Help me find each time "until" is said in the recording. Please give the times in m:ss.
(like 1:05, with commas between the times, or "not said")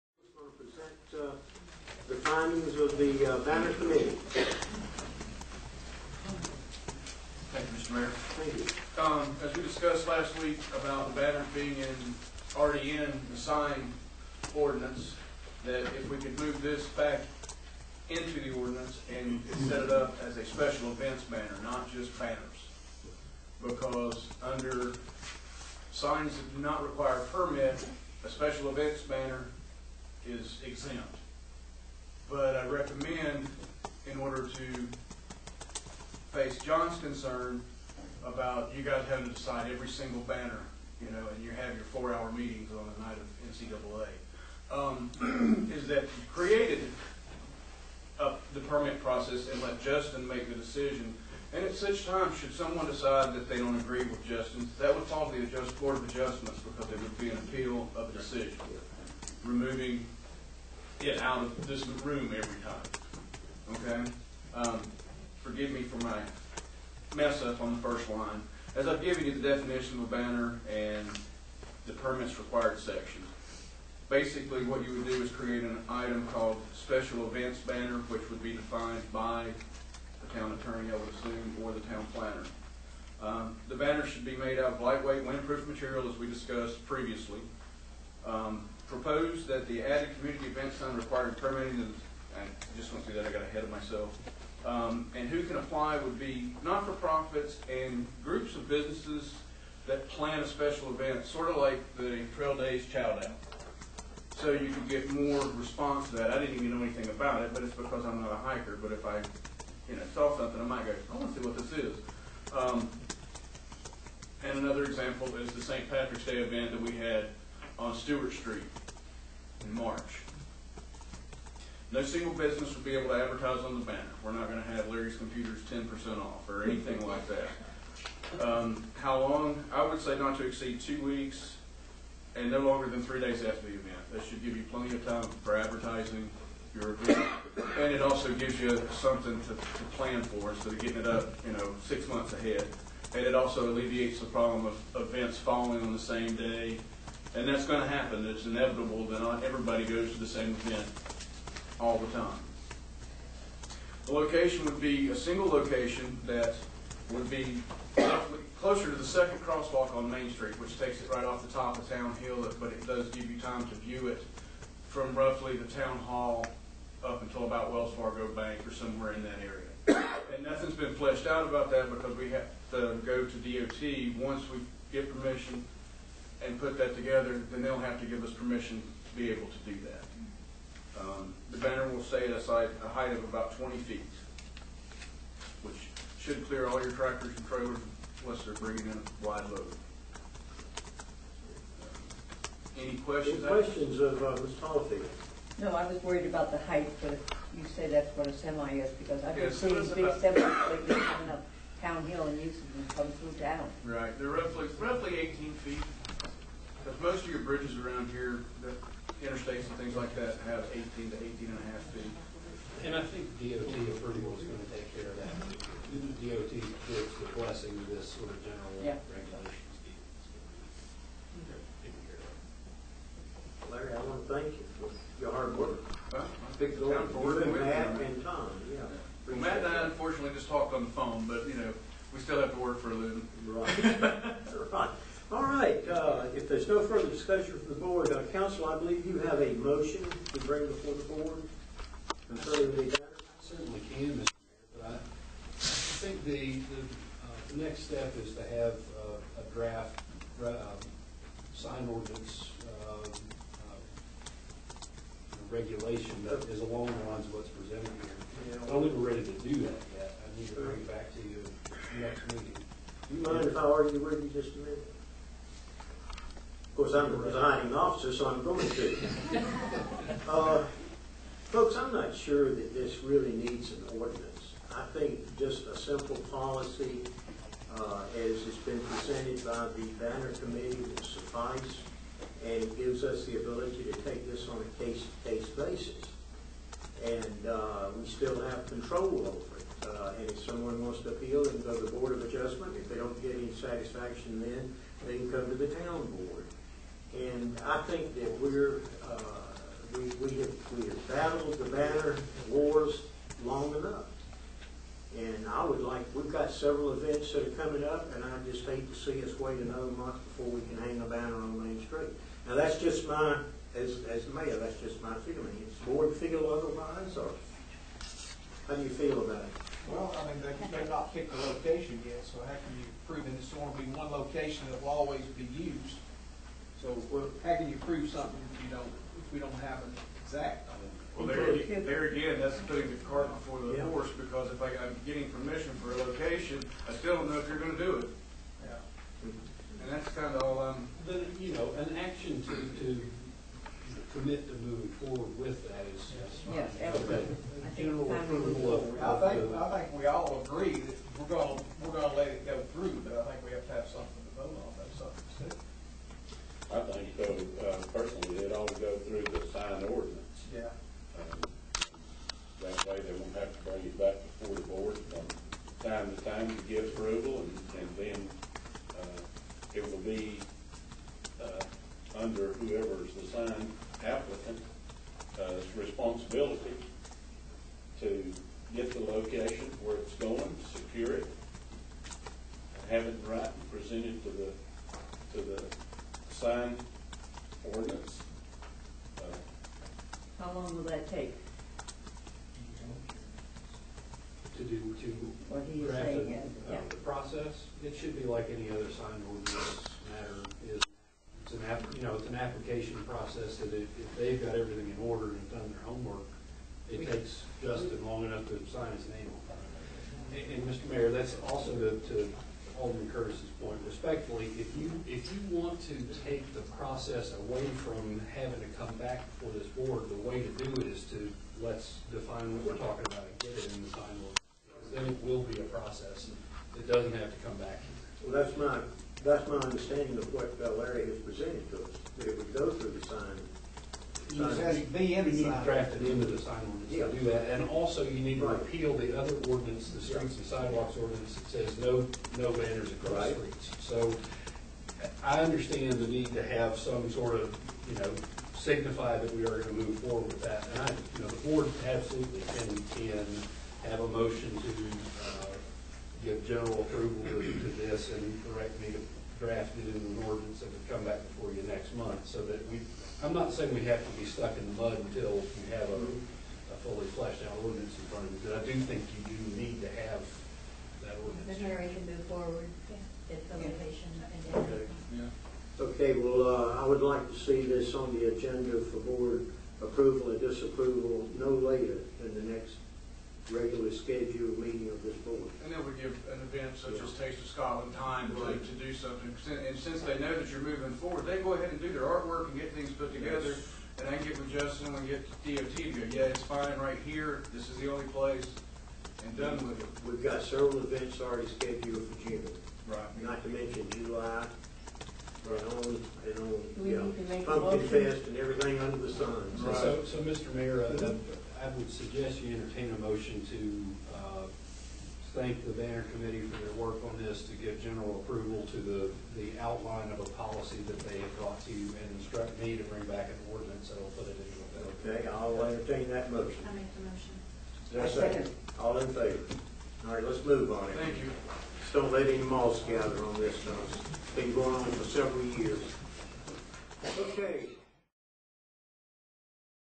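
2:47, 7:44.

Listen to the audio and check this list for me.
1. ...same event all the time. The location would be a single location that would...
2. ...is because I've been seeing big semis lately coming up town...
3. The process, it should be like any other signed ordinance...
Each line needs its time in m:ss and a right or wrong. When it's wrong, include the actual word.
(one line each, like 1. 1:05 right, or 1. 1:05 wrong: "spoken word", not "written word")
1. 2:30 right
2. 3:18 right
3. 6:36 right.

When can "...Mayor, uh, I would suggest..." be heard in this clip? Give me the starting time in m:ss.
8:30.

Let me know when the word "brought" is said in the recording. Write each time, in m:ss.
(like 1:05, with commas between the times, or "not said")
8:41.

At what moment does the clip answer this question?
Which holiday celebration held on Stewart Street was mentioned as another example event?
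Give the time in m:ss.
1:55.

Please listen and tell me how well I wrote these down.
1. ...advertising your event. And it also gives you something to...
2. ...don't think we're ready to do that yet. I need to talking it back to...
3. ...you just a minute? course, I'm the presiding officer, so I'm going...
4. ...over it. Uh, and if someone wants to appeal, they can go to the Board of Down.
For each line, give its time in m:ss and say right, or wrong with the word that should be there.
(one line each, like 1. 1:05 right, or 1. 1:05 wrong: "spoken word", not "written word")
1. 2:15 right
2. 4:18 wrong: "bring", not "talking"
3. 4:24 right
4. 4:49 wrong: "Adjustment", not "Down".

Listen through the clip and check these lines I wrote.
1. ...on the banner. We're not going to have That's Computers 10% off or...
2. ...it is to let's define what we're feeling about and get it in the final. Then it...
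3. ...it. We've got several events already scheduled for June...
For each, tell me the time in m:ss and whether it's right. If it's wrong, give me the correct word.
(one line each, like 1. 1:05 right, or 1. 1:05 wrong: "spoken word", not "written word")
1. 2:03 wrong: "Larry", not "That"
2. 7:00 wrong: "talking", not "feeling"
3. 8:19 right.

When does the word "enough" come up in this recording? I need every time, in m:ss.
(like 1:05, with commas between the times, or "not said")
5:03, 6:48.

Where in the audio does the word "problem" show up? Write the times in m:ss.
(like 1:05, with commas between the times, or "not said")
2:24.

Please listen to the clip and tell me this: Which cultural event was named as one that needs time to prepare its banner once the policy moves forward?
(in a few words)
Taste of Scotland.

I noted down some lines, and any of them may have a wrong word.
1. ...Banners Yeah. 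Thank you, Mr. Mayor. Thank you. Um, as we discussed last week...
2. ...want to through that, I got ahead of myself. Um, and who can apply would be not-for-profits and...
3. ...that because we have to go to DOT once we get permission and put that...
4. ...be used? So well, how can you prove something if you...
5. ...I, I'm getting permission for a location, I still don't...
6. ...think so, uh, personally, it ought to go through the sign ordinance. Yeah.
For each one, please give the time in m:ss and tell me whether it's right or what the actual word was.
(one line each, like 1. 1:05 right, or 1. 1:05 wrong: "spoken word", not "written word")
1. 0:03 wrong: "Committee", not "Yeah"
2. 1:32 right
3. 2:51 right
4. 5:25 right
5. 5:34 right
6. 5:56 right.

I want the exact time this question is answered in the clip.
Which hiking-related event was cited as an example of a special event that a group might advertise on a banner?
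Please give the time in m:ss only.
1:42.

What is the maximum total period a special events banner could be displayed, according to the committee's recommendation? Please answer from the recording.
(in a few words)
2 weeks.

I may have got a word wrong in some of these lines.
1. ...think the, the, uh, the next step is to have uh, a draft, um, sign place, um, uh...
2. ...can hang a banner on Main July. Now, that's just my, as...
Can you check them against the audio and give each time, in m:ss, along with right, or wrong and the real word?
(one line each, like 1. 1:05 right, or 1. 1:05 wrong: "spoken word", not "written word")
1. 4:05 wrong: "ordinance", not "place"
2. 5:10 wrong: "Street", not "July".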